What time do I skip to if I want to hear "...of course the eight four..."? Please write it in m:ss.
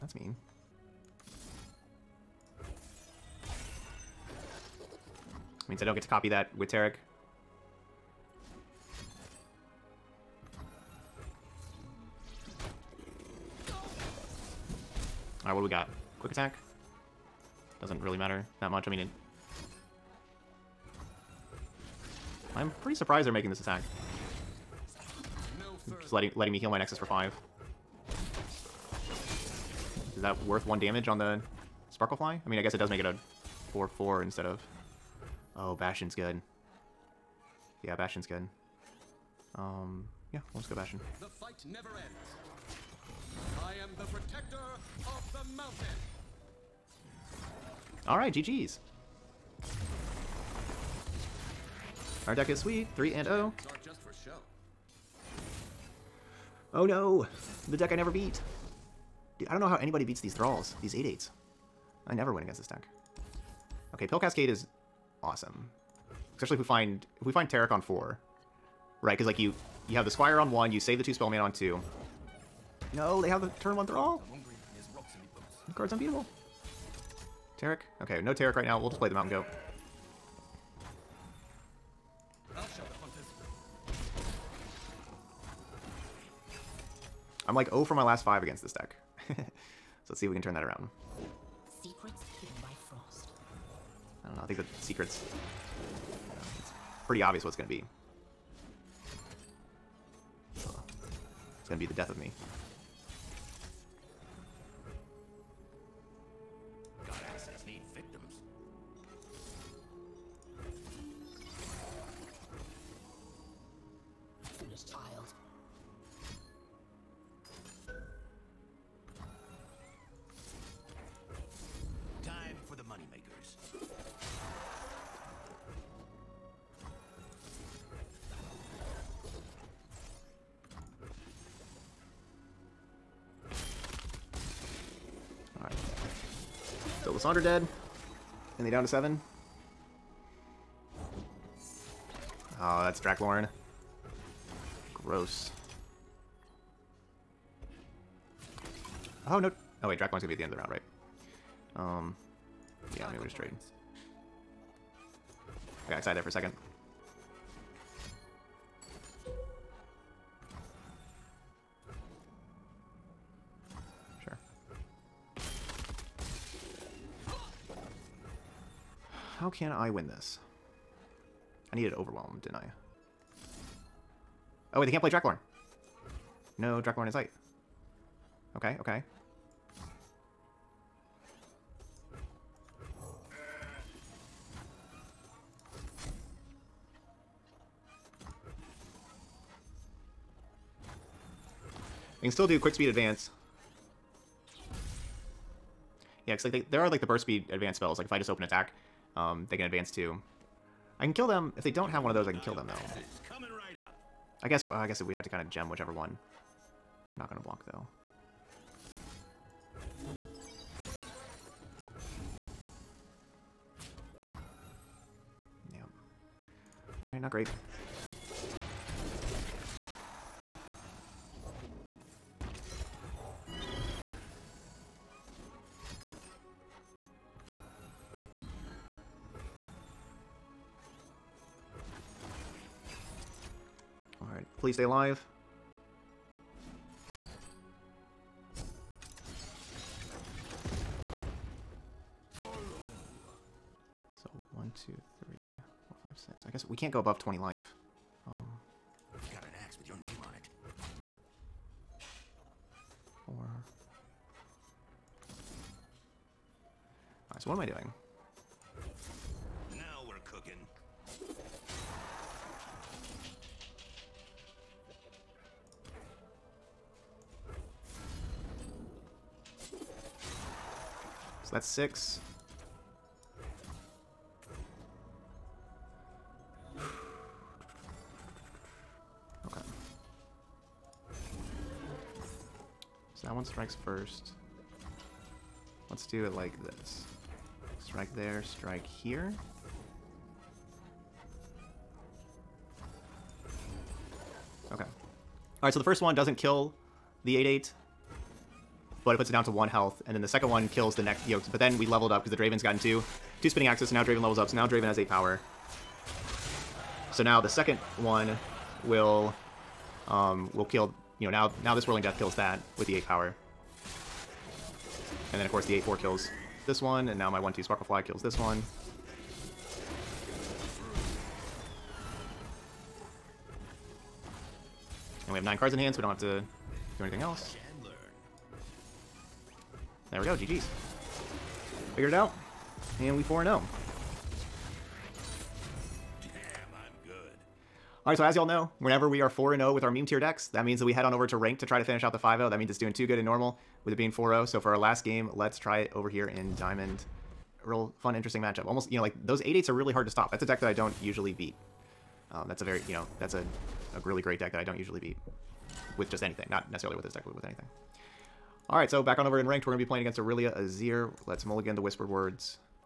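5:15.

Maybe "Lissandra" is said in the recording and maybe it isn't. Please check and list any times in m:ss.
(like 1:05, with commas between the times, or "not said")
2:17.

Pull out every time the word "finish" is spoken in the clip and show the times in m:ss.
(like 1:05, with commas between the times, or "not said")
5:41.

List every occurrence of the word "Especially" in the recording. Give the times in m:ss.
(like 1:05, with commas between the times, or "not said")
1:06.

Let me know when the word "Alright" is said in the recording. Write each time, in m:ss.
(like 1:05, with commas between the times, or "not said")
0:15, 3:37, 4:17, 4:55.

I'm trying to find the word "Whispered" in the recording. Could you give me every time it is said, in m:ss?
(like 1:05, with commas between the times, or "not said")
6:01.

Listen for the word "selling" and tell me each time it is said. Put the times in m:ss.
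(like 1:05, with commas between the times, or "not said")
not said.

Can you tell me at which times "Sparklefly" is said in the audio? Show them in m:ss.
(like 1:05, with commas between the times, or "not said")
0:31, 5:17.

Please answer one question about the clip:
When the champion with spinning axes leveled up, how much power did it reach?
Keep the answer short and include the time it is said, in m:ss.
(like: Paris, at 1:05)
8, at 5:04.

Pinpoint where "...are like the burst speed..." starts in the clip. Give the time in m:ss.
3:16.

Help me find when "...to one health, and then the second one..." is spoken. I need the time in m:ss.
4:59.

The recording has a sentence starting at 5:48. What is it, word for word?
Almost, you know, like those 8 8s are really hard to stop.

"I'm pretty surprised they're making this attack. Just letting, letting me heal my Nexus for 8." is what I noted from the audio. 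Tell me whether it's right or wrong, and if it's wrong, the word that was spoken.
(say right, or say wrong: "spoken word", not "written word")
wrong: "5", not "8".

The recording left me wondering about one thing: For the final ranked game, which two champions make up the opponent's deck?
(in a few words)
Irelia Azir.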